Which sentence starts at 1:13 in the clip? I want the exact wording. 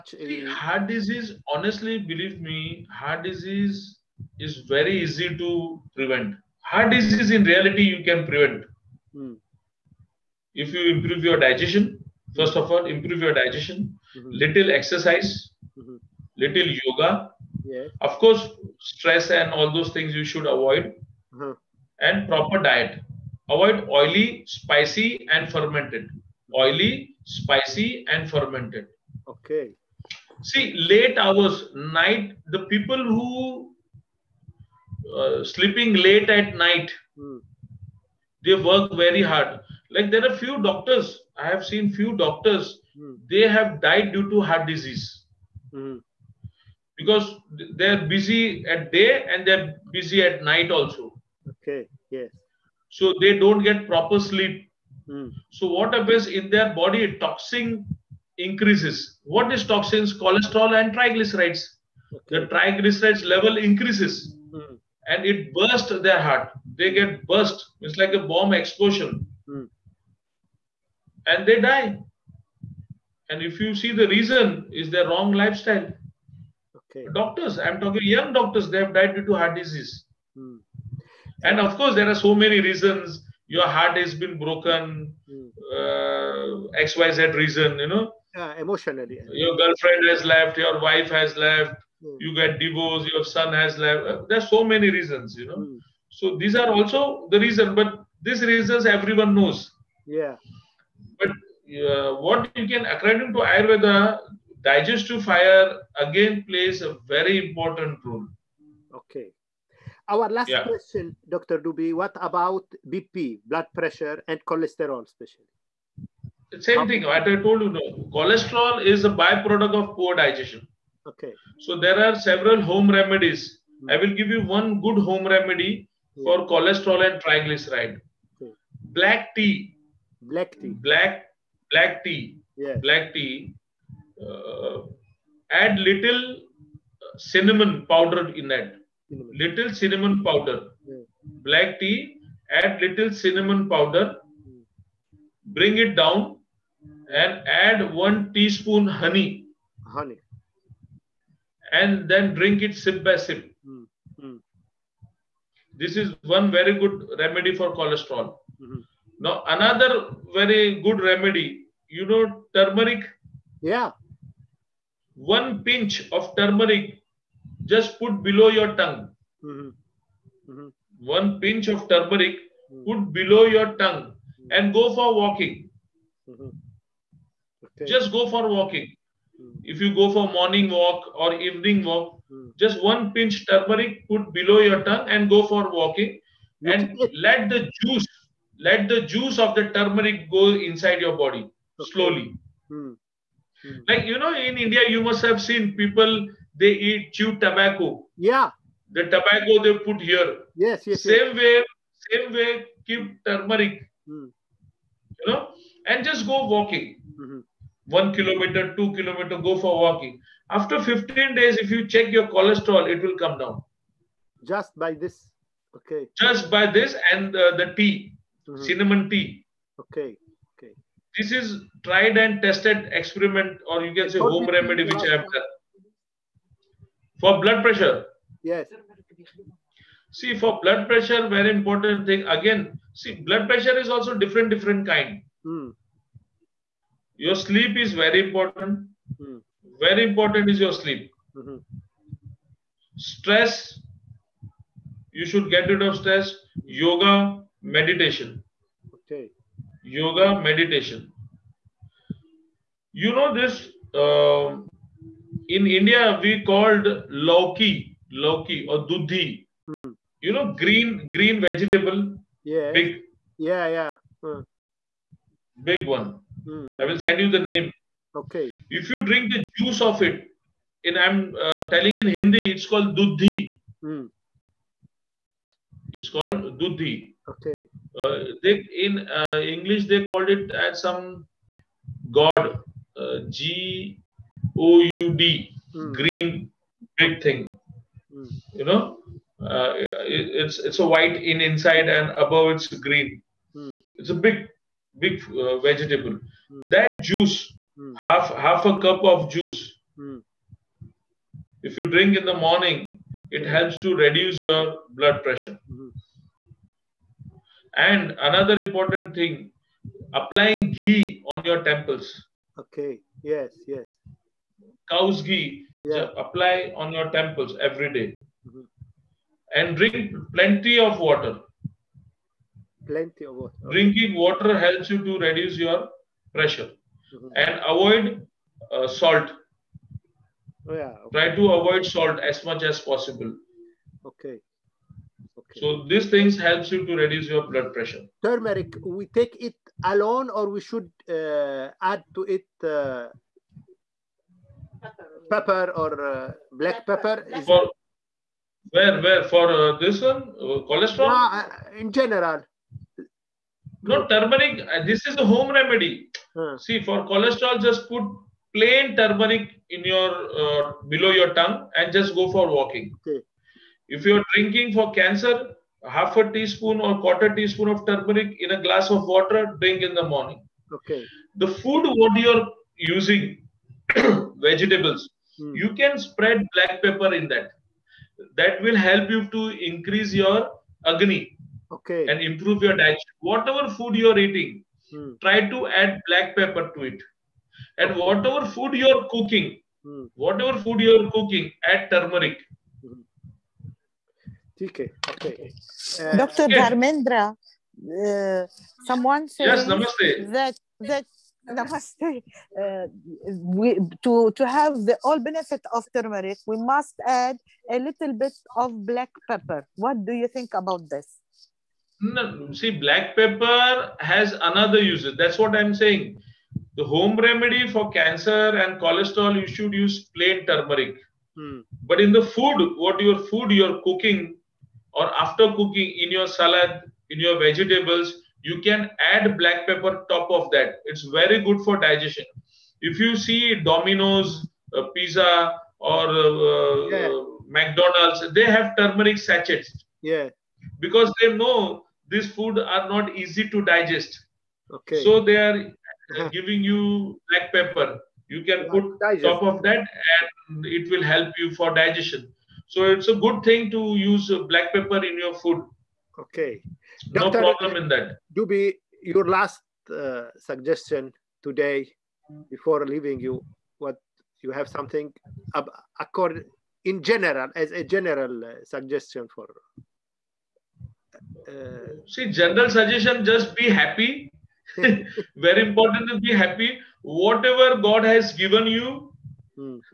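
And if you see the reason is their wrong lifestyle.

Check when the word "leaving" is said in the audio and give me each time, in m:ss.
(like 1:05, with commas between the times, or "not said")
7:42.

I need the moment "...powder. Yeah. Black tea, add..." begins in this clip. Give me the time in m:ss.
2:20.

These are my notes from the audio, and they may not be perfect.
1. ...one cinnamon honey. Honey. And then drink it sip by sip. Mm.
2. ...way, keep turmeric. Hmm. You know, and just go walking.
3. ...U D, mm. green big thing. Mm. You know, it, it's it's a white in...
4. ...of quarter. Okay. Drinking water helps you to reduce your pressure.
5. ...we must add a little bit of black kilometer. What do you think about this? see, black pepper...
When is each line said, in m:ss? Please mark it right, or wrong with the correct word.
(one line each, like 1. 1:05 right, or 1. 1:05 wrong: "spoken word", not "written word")
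1. 2:27 wrong: "teaspoon", not "cinnamon"
2. 3:22 right
3. 4:44 right
4. 5:23 wrong: "water", not "quarter"
5. 6:46 wrong: "pepper", not "kilometer".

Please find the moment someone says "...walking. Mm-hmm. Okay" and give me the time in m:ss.
2:55.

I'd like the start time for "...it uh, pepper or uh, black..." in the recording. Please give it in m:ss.
5:42.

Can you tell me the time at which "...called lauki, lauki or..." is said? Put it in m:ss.
4:16.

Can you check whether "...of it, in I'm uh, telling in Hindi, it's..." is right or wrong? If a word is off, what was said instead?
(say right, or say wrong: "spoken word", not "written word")
right.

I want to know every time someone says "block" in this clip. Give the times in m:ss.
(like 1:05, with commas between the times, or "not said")
not said.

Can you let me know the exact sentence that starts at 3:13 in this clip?
Like you know, in India, you must have seen people they eat chew tobacco.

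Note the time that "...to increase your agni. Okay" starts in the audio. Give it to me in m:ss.
6:19.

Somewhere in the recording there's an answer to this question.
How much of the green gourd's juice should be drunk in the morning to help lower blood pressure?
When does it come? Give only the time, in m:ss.
4:58.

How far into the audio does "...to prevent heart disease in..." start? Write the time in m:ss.
0:05.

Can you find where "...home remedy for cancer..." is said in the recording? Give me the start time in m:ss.
6:56.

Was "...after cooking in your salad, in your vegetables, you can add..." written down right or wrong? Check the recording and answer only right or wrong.
right.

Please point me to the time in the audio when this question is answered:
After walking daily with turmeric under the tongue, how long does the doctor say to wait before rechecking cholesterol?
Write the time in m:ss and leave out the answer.
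3:30.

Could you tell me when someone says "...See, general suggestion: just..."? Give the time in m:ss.
7:52.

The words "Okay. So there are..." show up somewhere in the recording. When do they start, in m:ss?
2:01.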